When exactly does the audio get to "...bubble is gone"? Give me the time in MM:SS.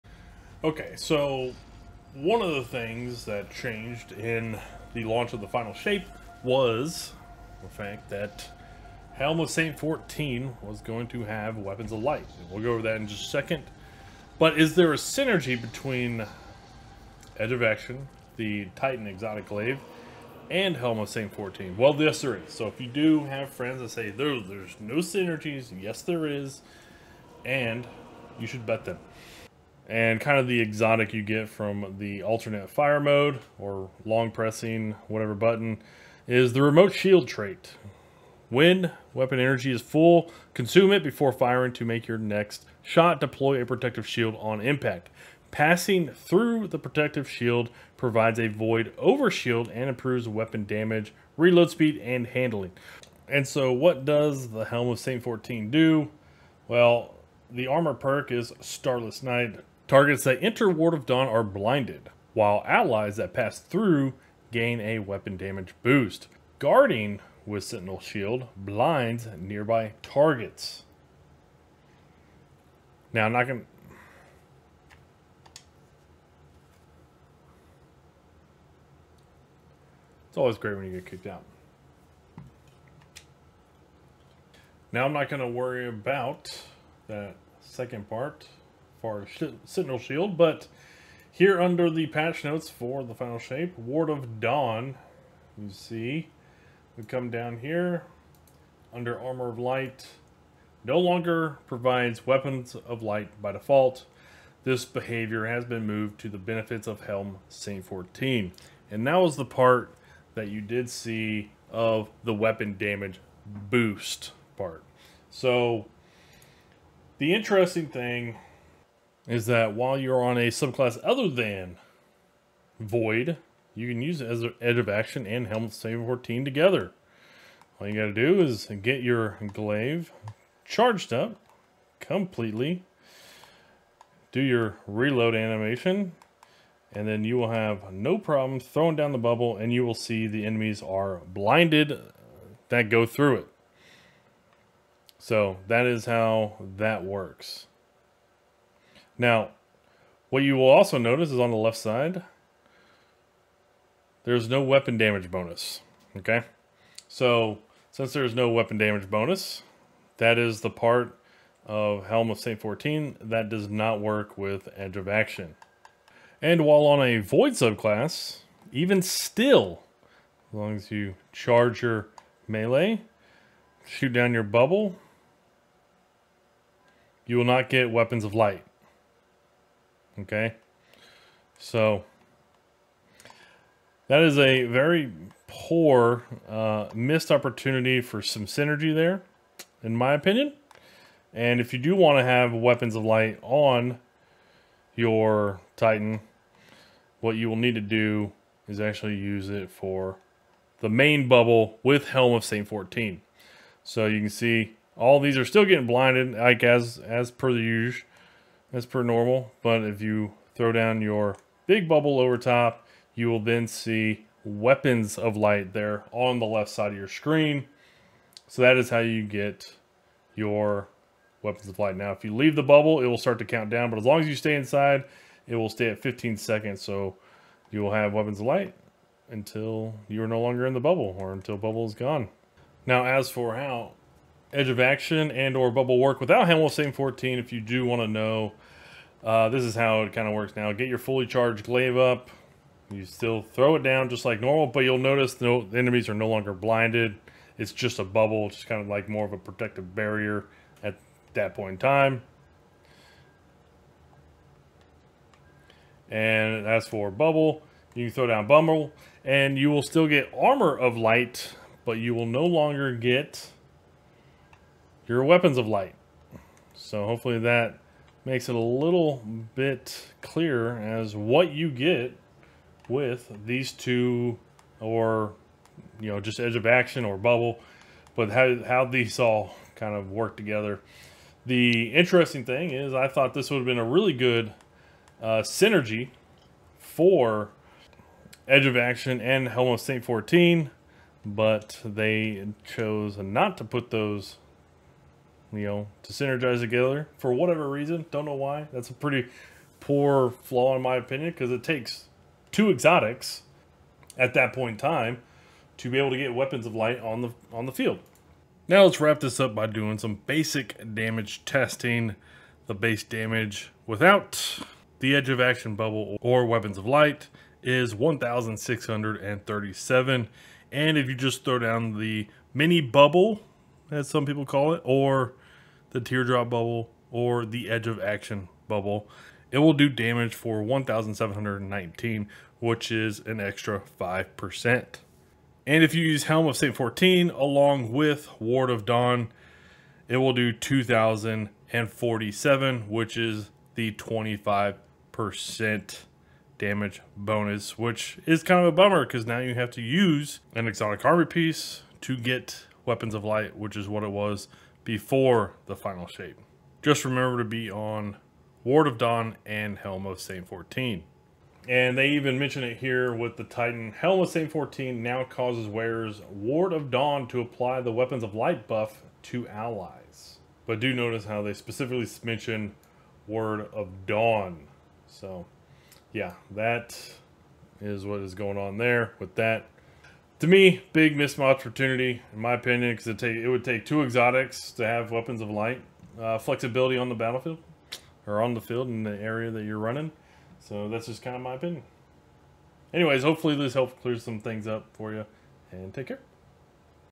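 03:51.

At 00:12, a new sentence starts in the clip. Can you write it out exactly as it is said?
And we'll go over that in just a second.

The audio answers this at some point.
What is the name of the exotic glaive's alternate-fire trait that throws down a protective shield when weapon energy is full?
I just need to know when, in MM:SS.
00:36.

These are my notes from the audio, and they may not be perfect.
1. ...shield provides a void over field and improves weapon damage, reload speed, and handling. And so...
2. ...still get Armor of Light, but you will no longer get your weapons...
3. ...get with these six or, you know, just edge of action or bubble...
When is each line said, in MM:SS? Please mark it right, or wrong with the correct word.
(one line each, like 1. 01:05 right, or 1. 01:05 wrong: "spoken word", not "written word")
1. 00:47 wrong: "shield", not "field"
2. 04:19 right
3. 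04:31 wrong: "two", not "six".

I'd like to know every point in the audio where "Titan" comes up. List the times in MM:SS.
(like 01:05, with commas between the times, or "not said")
00:18, 03:15, 06:03.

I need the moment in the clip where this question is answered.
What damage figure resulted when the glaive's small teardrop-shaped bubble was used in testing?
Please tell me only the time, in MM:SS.
05:30.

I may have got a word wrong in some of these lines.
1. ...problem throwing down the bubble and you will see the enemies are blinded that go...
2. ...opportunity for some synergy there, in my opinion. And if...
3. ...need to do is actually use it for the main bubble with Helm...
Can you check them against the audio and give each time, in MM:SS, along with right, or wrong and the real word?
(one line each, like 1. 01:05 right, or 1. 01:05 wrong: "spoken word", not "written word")
1. 02:18 right
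2. 03:07 right
3. 03:17 right.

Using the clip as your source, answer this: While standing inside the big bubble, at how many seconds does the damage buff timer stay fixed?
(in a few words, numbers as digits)
15 seconds.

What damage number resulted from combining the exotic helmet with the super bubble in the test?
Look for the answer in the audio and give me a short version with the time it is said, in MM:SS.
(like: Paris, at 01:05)
2,047, at 05:40.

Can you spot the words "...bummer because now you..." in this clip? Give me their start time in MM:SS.
05:48.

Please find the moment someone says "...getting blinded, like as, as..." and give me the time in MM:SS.
03:25.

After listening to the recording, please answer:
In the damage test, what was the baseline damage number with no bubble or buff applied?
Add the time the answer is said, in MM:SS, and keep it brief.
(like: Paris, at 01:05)
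1,637, at 05:17.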